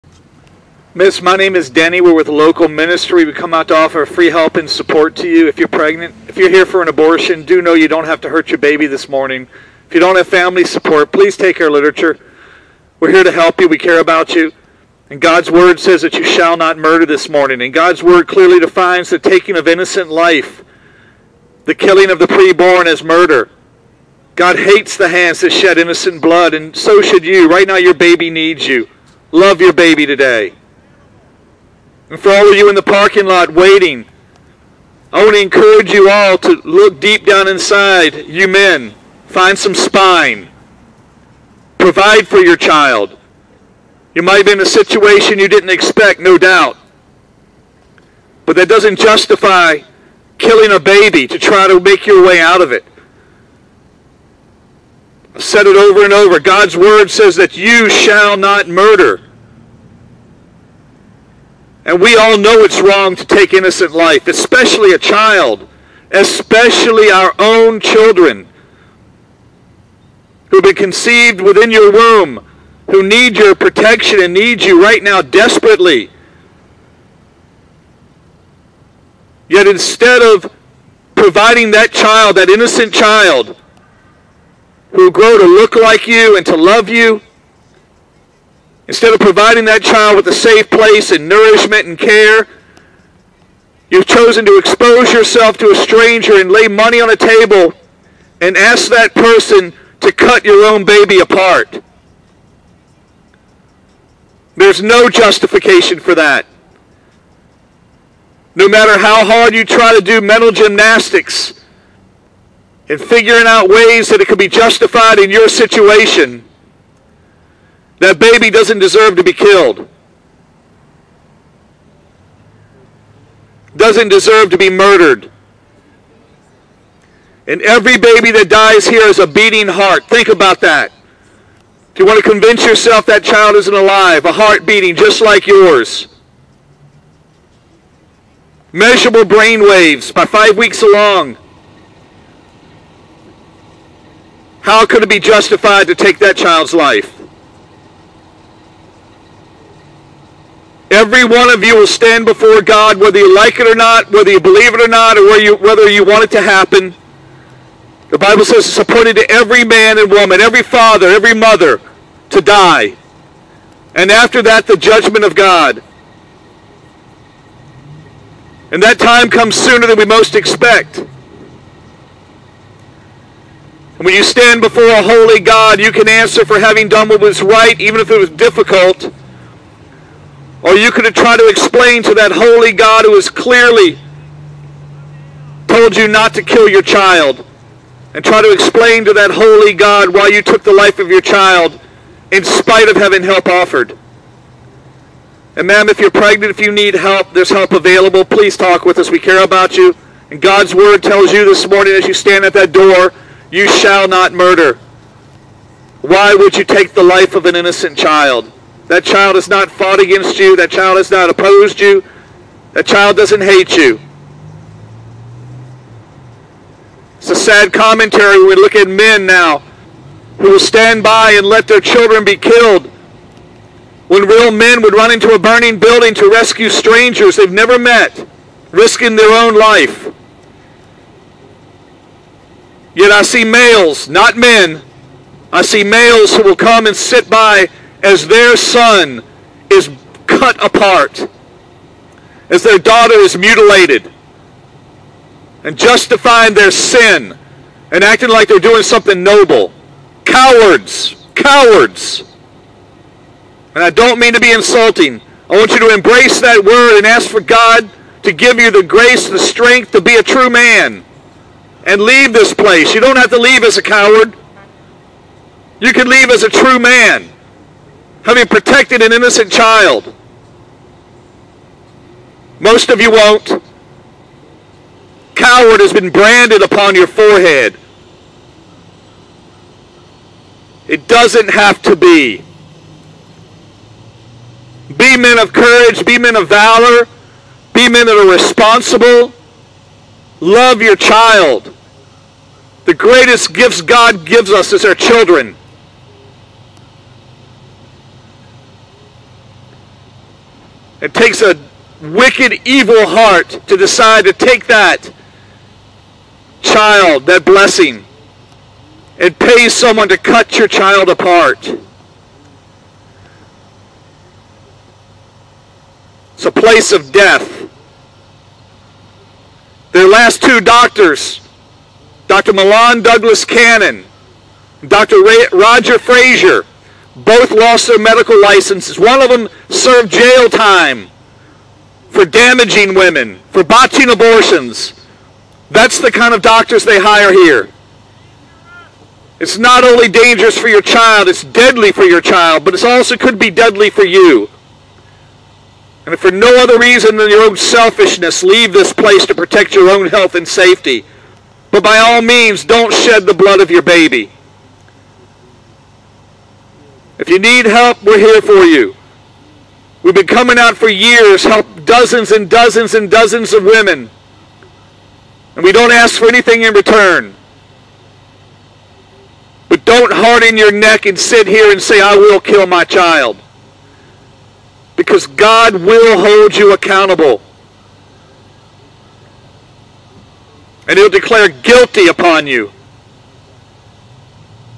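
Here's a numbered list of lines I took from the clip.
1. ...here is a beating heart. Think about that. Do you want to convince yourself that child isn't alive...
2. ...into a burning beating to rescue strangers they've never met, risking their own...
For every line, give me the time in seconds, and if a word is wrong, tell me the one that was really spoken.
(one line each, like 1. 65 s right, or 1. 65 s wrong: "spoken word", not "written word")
1. 128 s right
2. 225 s wrong: "building", not "beating".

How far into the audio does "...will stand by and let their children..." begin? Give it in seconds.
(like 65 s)
220 s.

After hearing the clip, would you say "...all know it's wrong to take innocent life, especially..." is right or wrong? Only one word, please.
right.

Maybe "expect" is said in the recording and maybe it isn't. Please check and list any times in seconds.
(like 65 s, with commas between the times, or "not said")
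45 s, 170 s.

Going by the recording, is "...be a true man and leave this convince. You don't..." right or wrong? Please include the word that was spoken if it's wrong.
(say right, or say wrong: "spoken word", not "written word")
wrong: "place", not "convince".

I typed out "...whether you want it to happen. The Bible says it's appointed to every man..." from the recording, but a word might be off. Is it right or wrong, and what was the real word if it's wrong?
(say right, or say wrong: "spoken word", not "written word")
right.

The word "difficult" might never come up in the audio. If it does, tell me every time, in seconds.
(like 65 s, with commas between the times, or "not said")
178 s.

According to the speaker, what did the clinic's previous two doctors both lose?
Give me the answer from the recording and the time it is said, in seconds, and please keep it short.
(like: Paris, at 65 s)
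Their medical licenses, at 327 s.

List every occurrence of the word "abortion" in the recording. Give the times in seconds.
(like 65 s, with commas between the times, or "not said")
6 s, 334 s.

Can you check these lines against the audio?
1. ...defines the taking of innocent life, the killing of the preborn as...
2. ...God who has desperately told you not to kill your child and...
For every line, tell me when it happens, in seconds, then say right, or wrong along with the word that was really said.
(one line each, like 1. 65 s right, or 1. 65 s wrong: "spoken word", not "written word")
1. 18 s right
2. 182 s wrong: "clearly", not "desperately".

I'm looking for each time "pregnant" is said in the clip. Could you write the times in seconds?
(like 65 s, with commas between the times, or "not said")
5 s, 196 s.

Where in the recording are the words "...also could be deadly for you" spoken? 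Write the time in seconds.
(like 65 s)
342 s.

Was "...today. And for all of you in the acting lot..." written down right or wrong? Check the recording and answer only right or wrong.
wrong.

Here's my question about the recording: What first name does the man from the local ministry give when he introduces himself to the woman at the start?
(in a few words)
Denny.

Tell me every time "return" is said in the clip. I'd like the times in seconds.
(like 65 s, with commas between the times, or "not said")
366 s.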